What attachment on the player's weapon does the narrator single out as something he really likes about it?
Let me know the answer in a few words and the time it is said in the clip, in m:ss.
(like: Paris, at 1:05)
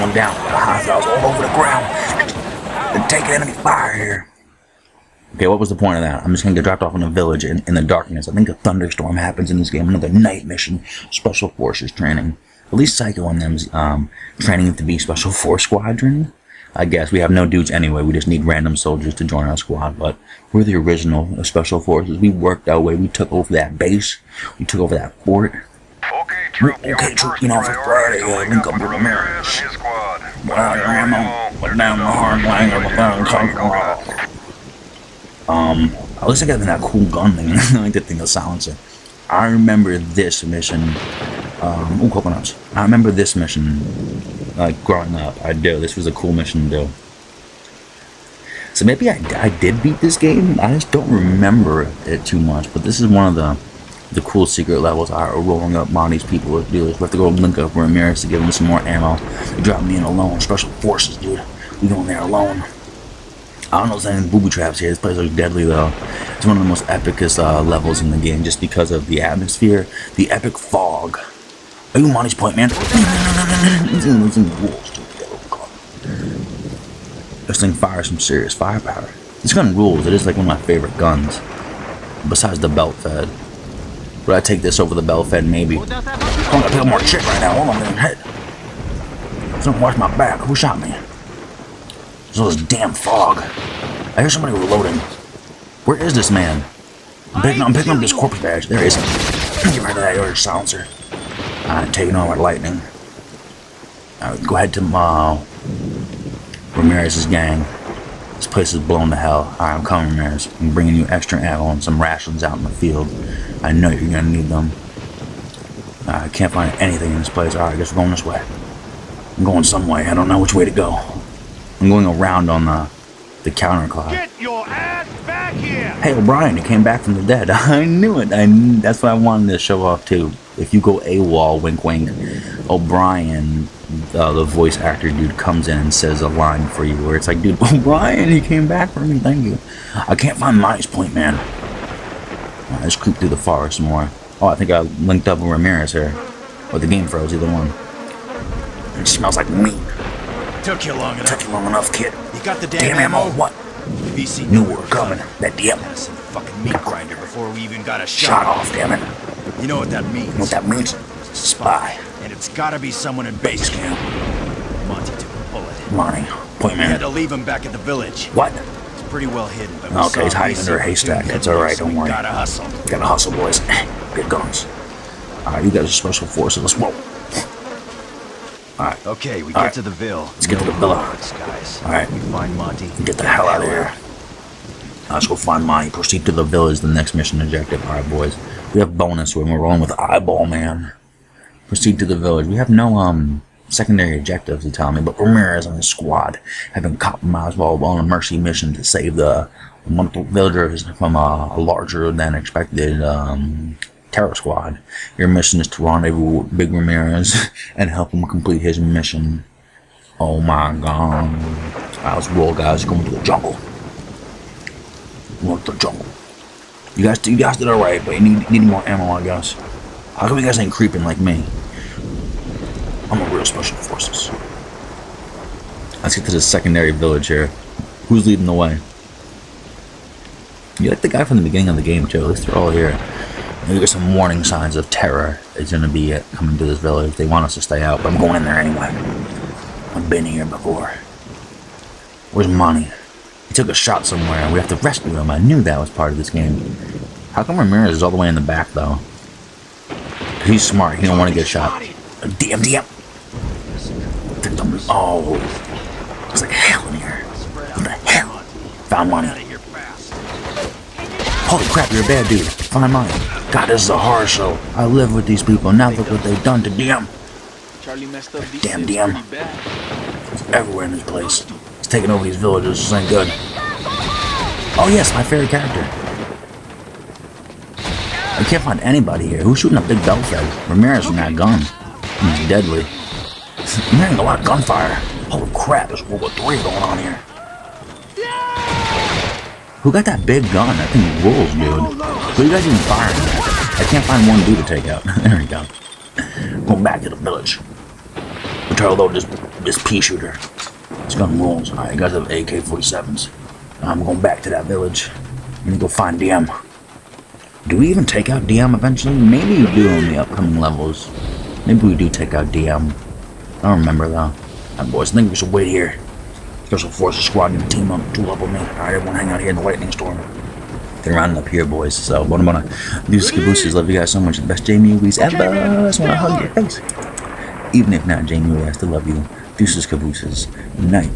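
The silencer, at 0:38.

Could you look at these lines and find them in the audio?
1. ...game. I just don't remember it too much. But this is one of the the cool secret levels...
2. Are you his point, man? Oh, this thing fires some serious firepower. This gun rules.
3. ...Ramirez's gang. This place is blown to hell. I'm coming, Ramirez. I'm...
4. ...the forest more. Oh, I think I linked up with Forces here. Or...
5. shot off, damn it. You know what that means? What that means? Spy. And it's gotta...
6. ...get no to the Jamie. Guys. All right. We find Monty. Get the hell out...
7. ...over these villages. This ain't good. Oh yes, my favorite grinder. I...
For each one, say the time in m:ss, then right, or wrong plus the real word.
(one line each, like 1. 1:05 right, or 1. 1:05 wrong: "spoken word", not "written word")
1. 0:50 right
2. 1:11 right
3. 1:46 right
4. 2:23 wrong: "Ramirez", not "Forces"
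5. 2:38 right
6. 3:00 wrong: "Villa", not "Jamie"
7. 4:32 wrong: "character", not "grinder".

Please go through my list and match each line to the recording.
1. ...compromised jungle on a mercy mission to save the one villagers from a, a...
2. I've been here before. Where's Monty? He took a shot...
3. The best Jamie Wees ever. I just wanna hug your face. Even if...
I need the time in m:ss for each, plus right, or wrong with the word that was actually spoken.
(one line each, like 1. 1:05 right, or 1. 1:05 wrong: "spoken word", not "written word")
1. 3:16 wrong: "while", not "jungle"
2. 3:59 right
3. 5:24 right.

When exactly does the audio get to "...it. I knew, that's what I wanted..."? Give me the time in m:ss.
2:08.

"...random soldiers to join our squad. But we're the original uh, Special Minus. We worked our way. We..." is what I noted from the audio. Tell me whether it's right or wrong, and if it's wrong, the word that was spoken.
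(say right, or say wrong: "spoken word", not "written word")
wrong: "Forces", not "Minus".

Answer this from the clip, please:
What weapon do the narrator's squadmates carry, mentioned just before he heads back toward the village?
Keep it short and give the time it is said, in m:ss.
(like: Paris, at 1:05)
AK-47s, at 5:02.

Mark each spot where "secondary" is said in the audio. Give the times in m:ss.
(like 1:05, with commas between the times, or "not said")
3:13, 3:46.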